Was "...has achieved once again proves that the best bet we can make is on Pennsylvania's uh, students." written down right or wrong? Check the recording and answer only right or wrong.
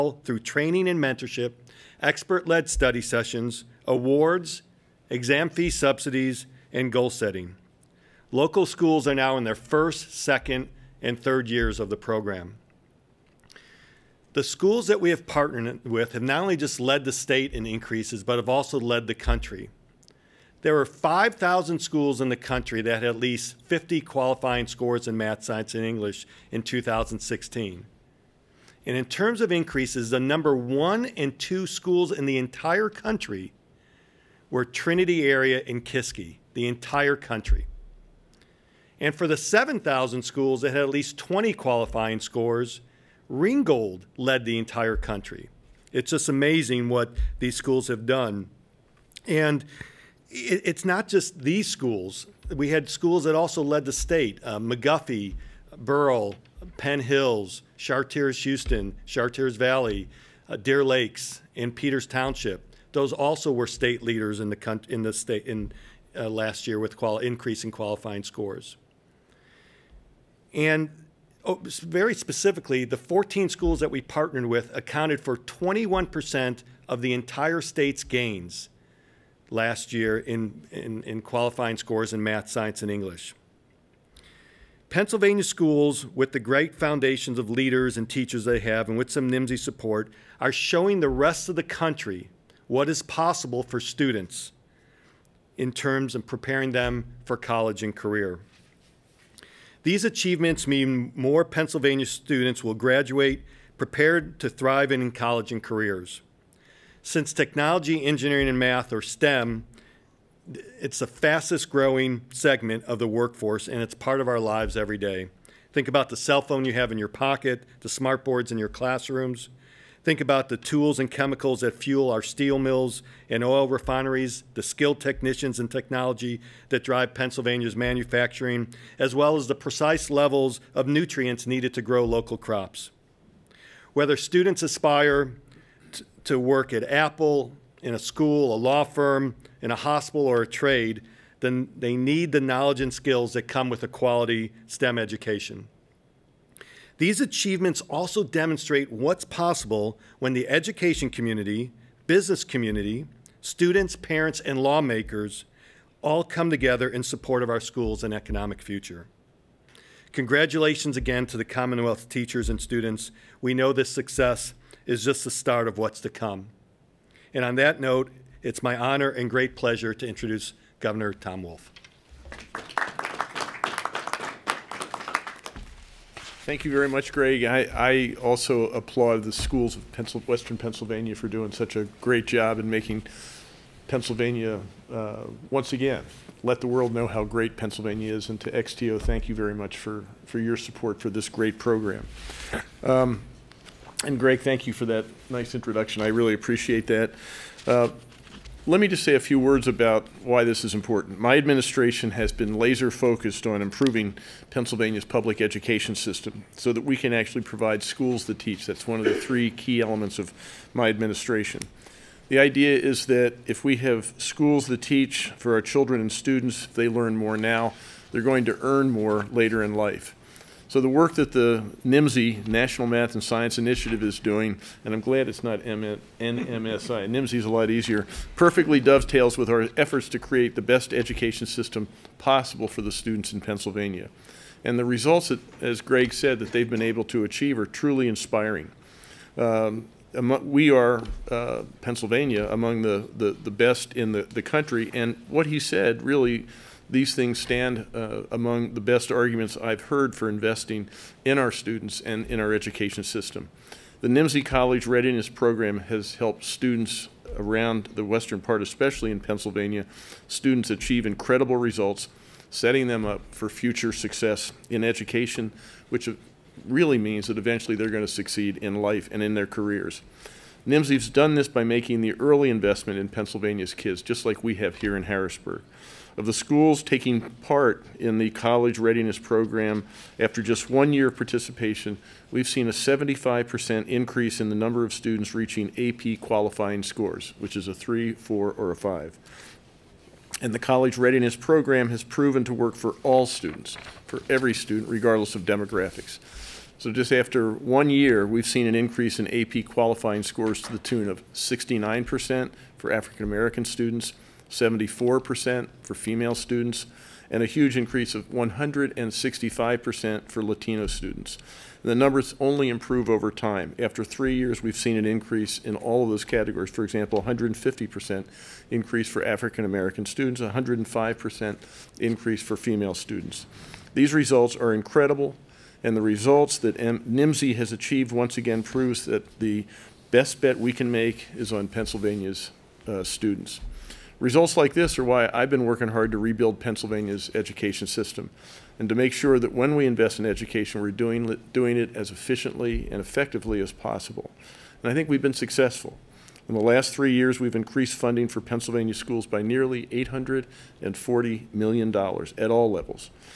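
right.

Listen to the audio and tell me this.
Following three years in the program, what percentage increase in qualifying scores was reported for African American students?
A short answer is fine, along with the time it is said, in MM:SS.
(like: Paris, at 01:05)
150%, at 05:17.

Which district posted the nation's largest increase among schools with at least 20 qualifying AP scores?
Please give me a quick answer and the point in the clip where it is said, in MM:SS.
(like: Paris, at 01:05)
Ringgold, at 00:43.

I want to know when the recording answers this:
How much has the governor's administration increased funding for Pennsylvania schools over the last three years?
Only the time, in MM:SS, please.
05:49.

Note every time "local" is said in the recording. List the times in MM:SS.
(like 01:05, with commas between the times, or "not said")
00:08, 02:12.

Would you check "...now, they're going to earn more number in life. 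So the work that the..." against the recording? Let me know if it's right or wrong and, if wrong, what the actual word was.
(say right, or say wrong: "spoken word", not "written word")
wrong: "later", not "number".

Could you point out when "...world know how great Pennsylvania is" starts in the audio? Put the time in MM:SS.
03:06.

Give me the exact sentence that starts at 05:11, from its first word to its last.
the numbers only improve over time.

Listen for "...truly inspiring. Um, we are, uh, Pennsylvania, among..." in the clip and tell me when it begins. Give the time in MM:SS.
03:57.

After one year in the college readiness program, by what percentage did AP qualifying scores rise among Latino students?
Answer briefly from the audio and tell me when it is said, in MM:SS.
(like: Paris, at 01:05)
165%, at 05:08.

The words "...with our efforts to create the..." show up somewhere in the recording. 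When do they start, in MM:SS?
03:49.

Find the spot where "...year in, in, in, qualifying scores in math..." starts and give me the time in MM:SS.
01:19.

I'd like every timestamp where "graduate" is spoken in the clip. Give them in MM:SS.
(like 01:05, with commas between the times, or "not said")
01:42.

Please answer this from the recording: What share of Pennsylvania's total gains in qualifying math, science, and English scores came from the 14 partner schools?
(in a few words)
21%.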